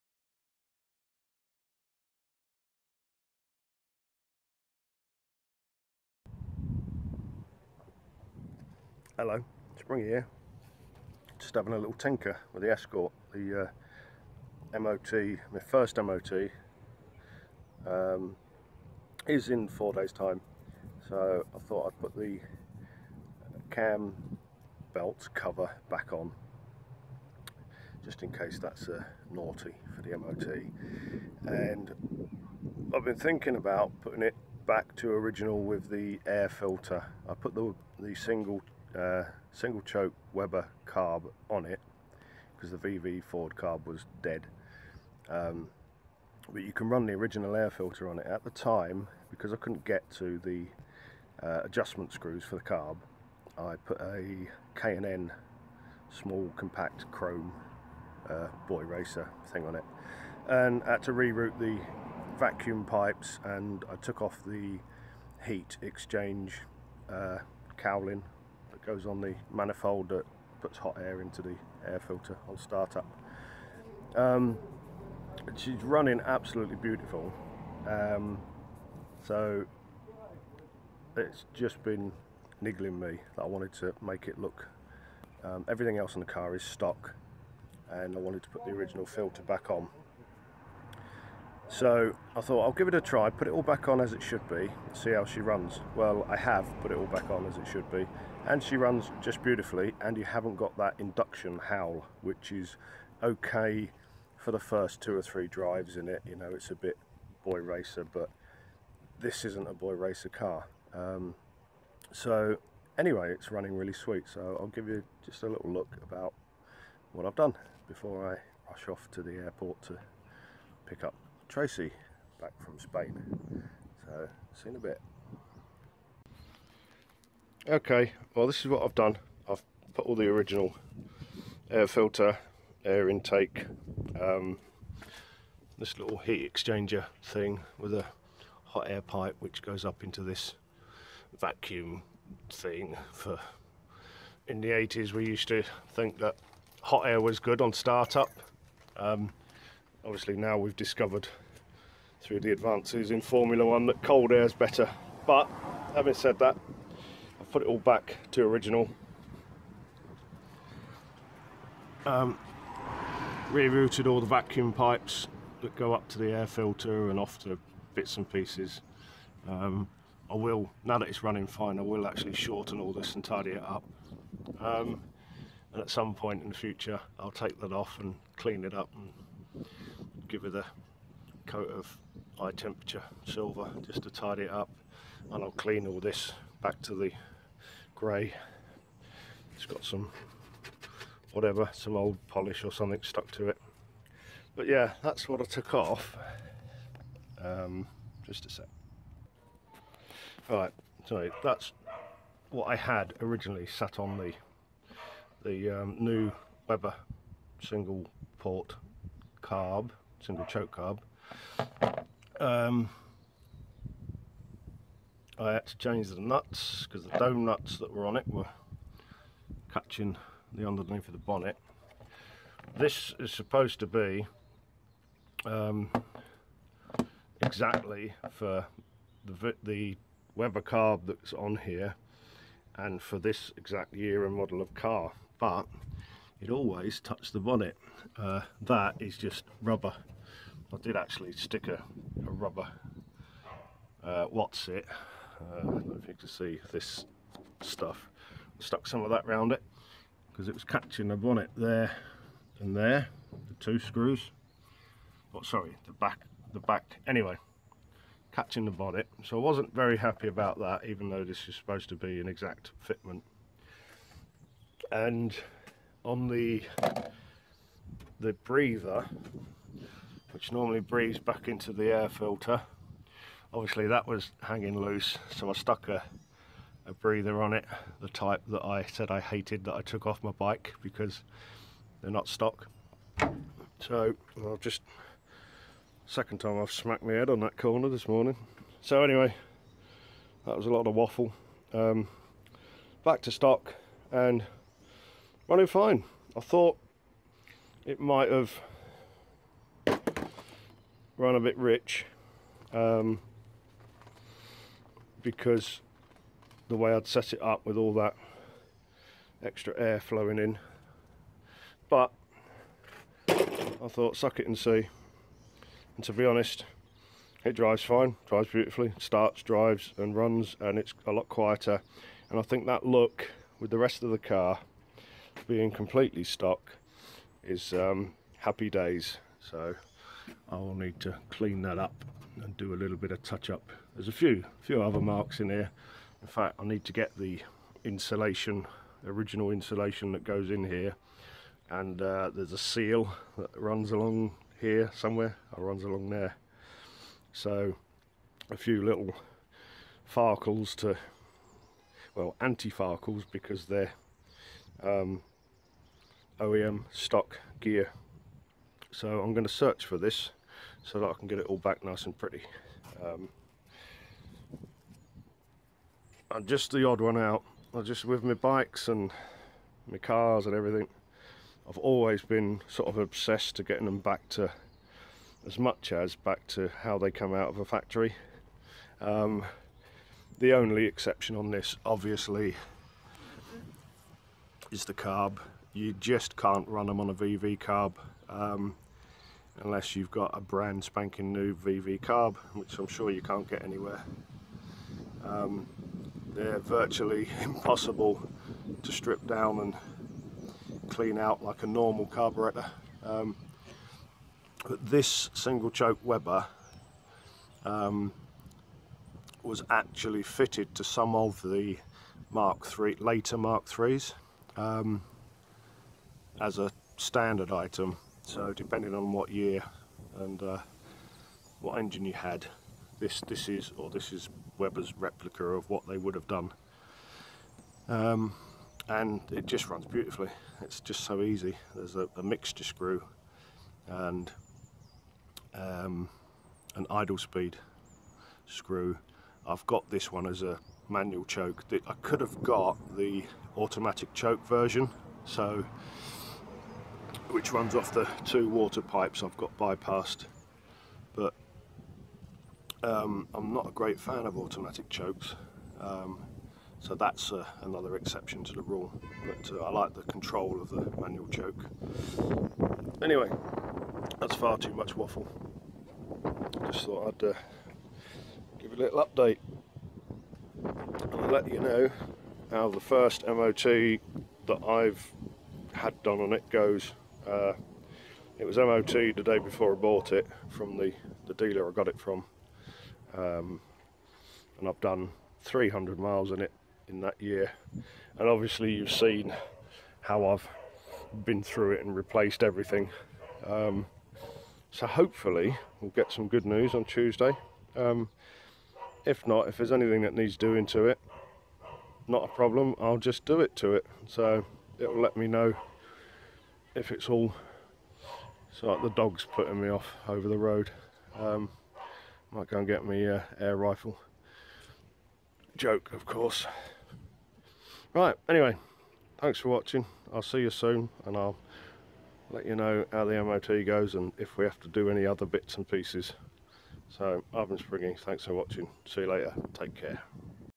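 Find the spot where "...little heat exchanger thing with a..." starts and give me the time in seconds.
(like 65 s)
135 s.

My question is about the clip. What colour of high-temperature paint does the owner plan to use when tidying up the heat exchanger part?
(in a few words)
silver.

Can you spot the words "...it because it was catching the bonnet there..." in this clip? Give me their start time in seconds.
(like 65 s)
249 s.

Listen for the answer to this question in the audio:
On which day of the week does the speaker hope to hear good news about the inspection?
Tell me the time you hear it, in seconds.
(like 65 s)
496 s.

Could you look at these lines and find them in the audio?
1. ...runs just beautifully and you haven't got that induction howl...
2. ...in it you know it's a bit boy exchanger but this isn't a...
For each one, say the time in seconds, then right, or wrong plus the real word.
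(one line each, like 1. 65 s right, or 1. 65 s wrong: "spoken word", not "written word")
1. 98 s right
2. 105 s wrong: "racer", not "exchanger".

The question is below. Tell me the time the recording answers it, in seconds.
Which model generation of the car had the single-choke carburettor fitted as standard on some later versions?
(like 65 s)
412 s.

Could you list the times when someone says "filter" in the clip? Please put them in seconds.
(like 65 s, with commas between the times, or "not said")
36 s, 47 s, 72 s, 89 s, 131 s, 166 s, 272 s.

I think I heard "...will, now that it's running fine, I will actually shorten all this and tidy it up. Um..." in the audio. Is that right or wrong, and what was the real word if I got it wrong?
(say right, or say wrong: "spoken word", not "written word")
right.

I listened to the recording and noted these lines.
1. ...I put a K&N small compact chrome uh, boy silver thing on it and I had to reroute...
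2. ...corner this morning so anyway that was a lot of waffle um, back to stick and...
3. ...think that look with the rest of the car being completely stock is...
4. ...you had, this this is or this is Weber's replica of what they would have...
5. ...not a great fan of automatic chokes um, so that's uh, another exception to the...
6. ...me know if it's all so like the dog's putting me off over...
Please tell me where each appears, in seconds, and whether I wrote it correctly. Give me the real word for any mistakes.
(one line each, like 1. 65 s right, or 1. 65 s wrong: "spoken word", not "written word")
1. 53 s wrong: "racer", not "silver"
2. 287 s wrong: "stock", not "stick"
3. 322 s right
4. 422 s right
5. 453 s right
6. 505 s right.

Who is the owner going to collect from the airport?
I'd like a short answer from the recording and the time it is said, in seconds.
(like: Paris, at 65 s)
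Tracy, at 121 s.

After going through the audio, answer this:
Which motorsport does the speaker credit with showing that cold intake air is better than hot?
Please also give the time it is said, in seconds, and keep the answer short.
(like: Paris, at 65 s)
Formula One, at 153 s.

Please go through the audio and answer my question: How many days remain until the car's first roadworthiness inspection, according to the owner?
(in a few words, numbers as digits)
4.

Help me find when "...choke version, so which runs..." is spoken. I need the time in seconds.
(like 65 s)
444 s.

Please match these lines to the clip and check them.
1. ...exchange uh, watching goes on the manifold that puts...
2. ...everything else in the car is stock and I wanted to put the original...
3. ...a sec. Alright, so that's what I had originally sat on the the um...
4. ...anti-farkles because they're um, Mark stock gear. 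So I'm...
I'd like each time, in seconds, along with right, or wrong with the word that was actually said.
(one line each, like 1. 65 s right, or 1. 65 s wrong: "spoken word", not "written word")
1. 65 s wrong: "cowling", not "watching"
2. 85 s right
3. 198 s right
4. 352 s wrong: "OEM", not "Mark".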